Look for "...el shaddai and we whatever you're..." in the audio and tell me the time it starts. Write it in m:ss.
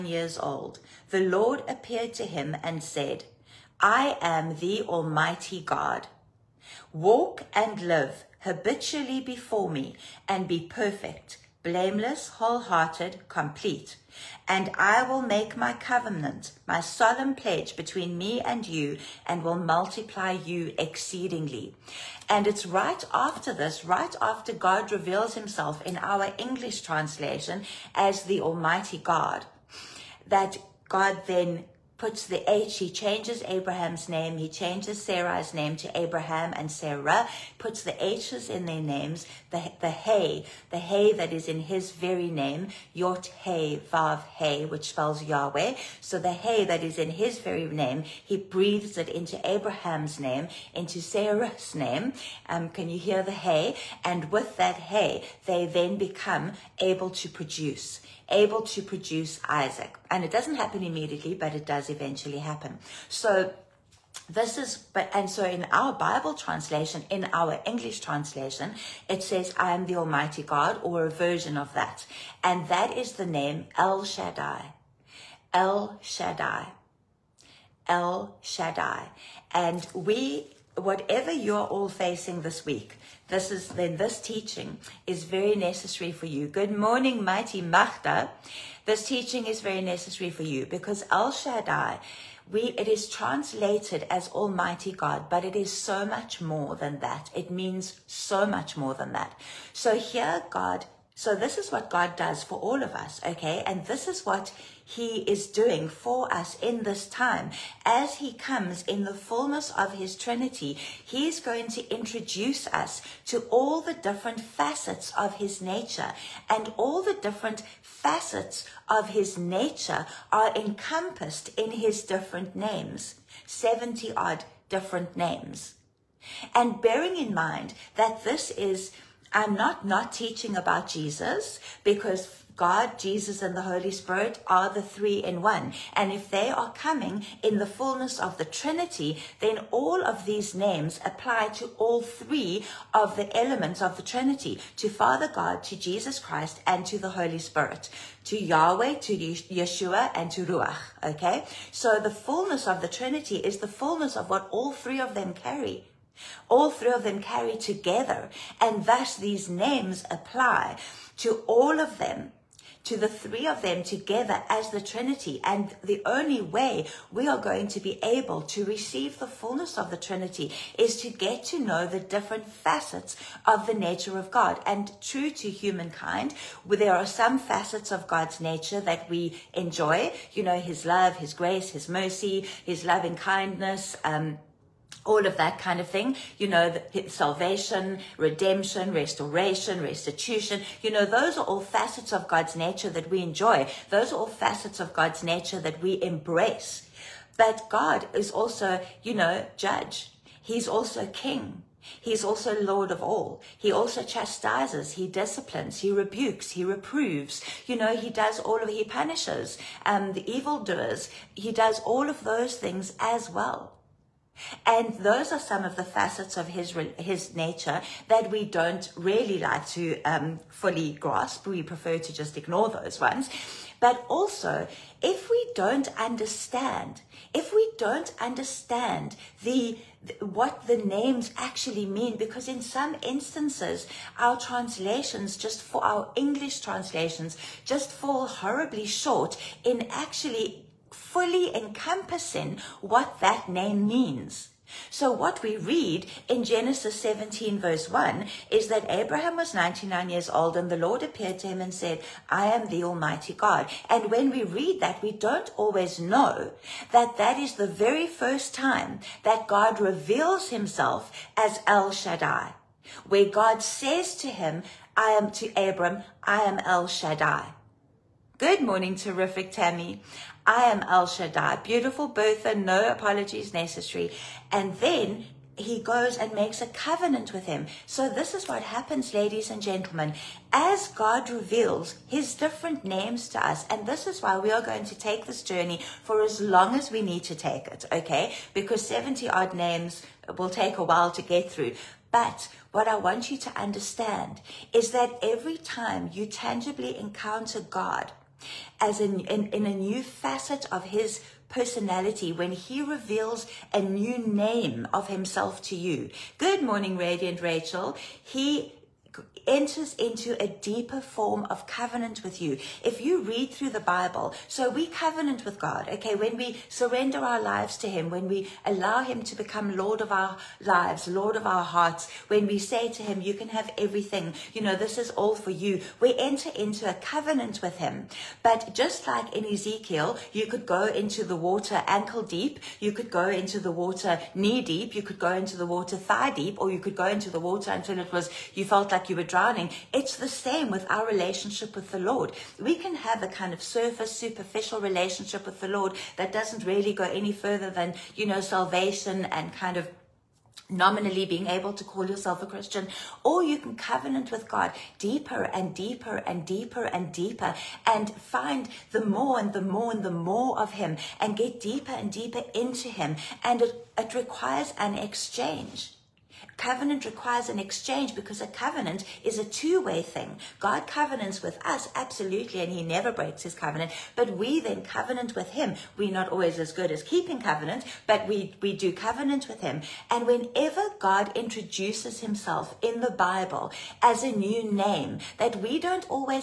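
1:17.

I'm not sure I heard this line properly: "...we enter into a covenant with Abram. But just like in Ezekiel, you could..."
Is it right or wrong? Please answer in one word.
wrong.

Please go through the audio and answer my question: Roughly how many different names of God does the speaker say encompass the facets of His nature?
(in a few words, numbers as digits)
70.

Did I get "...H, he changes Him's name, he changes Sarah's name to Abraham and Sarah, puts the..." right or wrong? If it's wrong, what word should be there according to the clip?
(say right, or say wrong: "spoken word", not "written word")
wrong: "Abraham", not "Him".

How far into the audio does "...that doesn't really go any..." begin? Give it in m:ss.
5:46.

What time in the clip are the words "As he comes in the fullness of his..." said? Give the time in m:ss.
1:47.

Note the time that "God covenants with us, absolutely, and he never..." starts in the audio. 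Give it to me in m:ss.
6:10.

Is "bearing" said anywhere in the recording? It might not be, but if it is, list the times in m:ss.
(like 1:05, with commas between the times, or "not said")
2:06.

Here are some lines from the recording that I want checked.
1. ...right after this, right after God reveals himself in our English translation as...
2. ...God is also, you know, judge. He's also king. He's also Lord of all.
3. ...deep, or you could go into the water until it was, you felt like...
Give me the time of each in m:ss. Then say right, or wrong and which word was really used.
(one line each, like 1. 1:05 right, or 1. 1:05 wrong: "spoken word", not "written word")
1. 0:22 right
2. 3:17 right
3. 5:36 right.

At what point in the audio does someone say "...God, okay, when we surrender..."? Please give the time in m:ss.
5:15.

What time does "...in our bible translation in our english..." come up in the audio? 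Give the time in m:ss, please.
1:05.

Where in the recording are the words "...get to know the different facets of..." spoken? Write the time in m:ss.
2:51.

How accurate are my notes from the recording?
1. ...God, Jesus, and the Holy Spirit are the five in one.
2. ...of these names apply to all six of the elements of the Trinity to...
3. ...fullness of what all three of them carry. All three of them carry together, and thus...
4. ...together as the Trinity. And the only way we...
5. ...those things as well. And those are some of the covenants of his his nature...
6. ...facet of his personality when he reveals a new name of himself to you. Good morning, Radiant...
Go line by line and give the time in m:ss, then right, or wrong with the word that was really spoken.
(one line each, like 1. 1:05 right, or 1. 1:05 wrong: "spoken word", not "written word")
1. 2:12 wrong: "three", not "five"
2. 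2:20 wrong: "three", not "six"
3. 2:33 right
4. 2:43 right
5. 3:32 wrong: "facets", not "covenants"
6. 5:00 right.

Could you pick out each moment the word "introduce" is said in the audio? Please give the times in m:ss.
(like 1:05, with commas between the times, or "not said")
1:51, 6:21.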